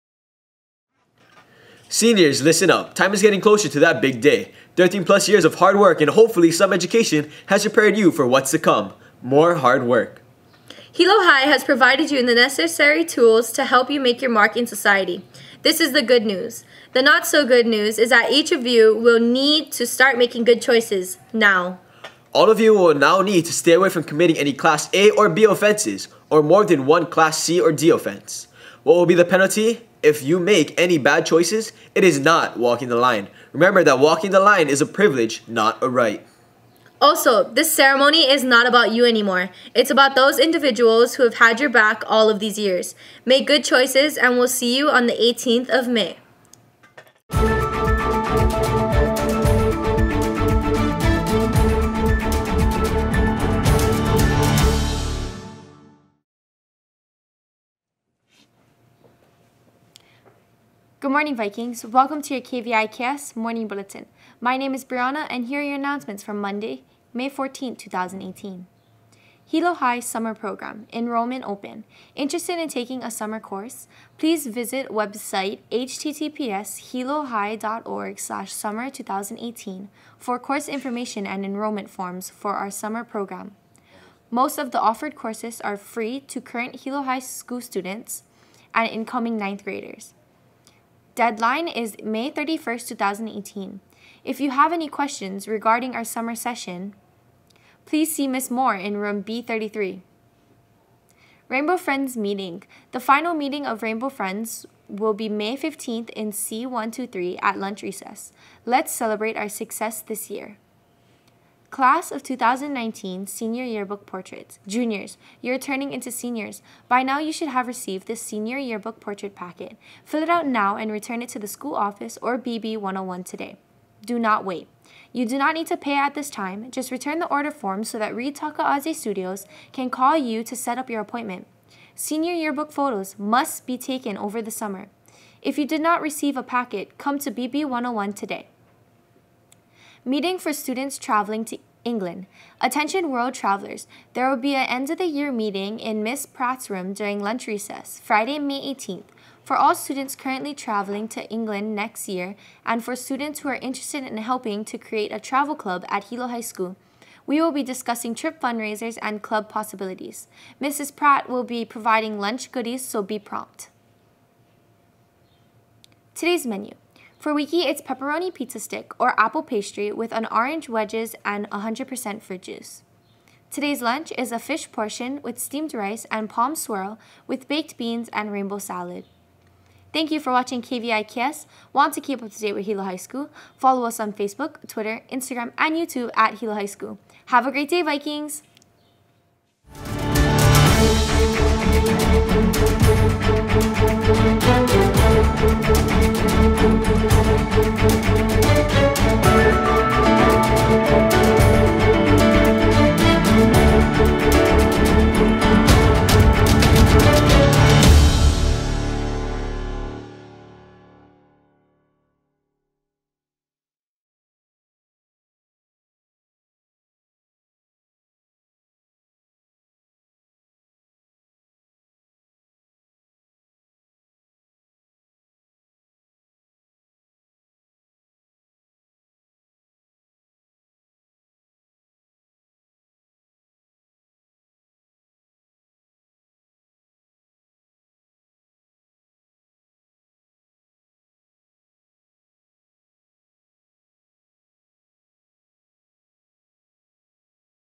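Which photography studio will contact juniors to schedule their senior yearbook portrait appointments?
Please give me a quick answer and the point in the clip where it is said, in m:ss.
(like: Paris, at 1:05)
Reed Takaaze Studios, at 2:08.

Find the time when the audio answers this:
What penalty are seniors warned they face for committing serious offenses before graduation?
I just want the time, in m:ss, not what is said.
0:31.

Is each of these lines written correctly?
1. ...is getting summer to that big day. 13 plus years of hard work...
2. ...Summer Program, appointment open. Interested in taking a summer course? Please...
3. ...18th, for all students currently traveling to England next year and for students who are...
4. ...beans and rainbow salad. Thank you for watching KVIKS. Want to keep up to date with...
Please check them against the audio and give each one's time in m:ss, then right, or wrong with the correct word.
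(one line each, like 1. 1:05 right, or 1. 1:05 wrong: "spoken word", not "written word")
1. 0:03 wrong: "closer", not "summer"
2. 1:09 wrong: "enrollment", not "appointment"
3. 2:28 right
4. 2:57 right.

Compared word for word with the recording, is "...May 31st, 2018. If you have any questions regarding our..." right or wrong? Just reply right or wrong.
right.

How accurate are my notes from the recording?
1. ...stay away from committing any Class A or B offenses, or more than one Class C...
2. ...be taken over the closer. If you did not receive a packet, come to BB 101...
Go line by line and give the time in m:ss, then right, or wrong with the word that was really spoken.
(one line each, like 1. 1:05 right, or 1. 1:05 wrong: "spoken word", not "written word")
1. 0:23 right
2. 2:13 wrong: "summer", not "closer".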